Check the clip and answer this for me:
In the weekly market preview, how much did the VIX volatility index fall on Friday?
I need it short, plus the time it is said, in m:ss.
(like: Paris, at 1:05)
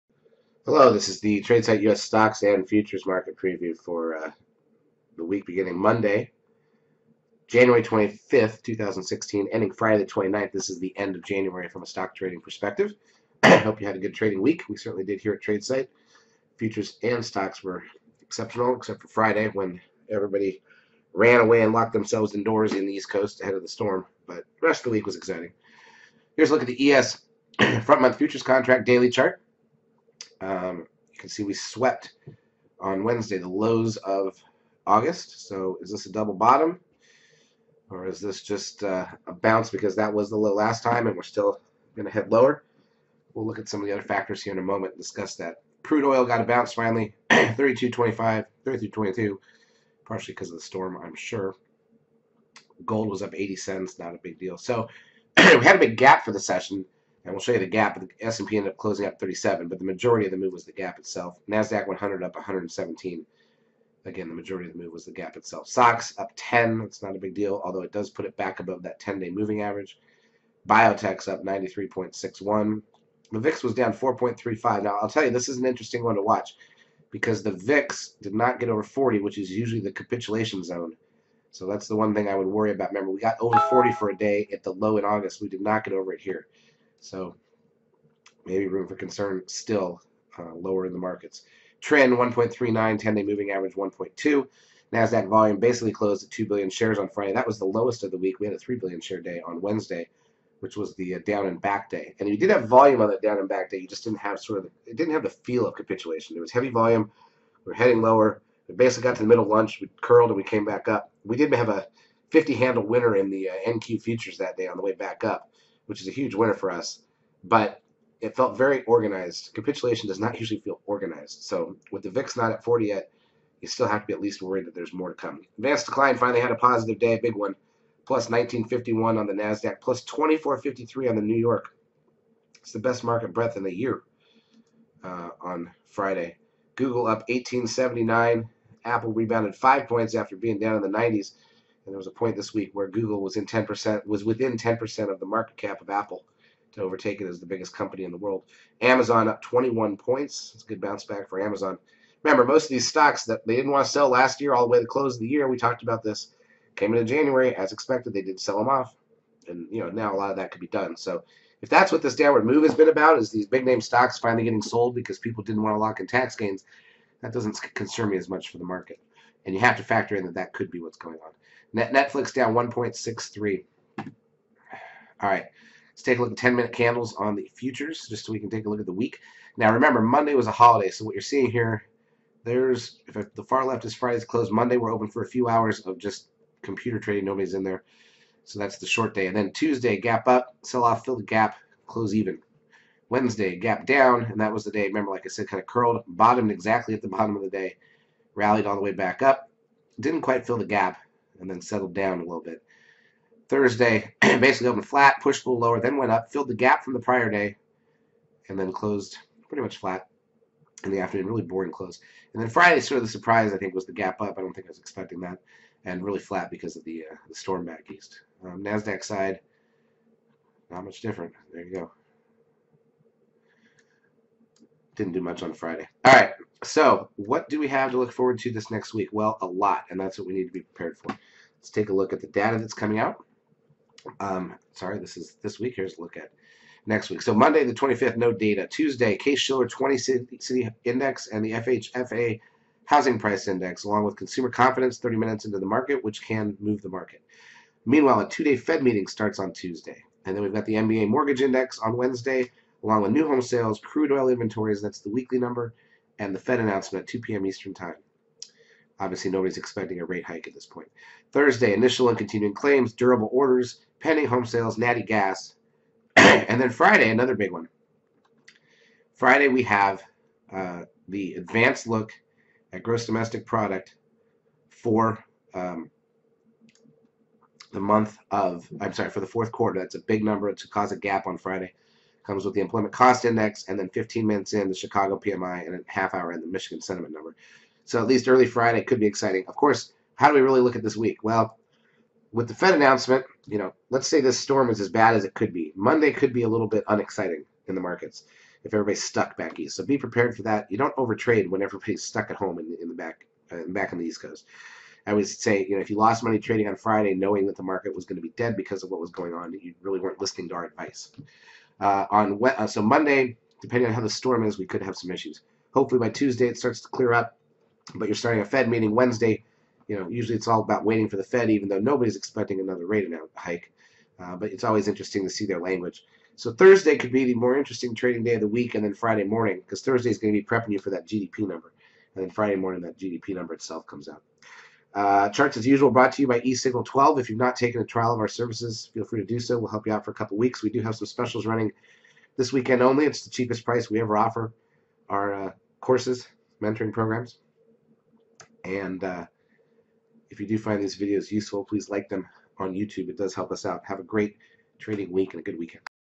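4.35, at 1:13.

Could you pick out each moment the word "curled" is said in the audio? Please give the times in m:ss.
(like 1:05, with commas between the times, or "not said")
1:50, 3:15.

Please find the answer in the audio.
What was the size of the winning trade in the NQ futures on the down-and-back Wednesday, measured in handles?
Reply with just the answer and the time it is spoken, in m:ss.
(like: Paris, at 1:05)
50, at 1:52.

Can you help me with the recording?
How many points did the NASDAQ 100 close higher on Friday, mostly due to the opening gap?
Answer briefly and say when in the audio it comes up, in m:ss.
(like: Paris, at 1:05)
117, at 1:02.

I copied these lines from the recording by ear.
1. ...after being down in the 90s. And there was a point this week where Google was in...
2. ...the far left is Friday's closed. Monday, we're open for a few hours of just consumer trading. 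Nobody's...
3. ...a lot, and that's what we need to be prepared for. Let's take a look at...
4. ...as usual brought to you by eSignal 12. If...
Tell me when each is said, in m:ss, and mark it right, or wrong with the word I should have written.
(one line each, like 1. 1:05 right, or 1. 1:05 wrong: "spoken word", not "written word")
1. 2:20 right
2. 3:03 wrong: "computer", not "consumer"
3. 3:49 right
4. 5:35 right.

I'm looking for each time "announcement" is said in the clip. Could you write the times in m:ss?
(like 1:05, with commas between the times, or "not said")
4:16, 4:52.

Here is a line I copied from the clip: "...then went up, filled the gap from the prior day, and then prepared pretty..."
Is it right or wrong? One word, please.
wrong.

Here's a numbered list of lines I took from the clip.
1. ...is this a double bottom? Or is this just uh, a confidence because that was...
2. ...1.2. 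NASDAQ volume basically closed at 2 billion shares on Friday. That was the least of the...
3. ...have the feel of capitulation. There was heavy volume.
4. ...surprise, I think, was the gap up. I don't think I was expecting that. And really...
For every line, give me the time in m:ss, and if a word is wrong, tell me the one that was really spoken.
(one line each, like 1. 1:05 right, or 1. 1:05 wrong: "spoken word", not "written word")
1. 0:35 wrong: "bounce", not "confidence"
2. 1:33 wrong: "lowest", not "least"
3. 1:45 right
4. 3:33 right.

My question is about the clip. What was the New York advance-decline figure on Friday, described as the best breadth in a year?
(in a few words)
+2453.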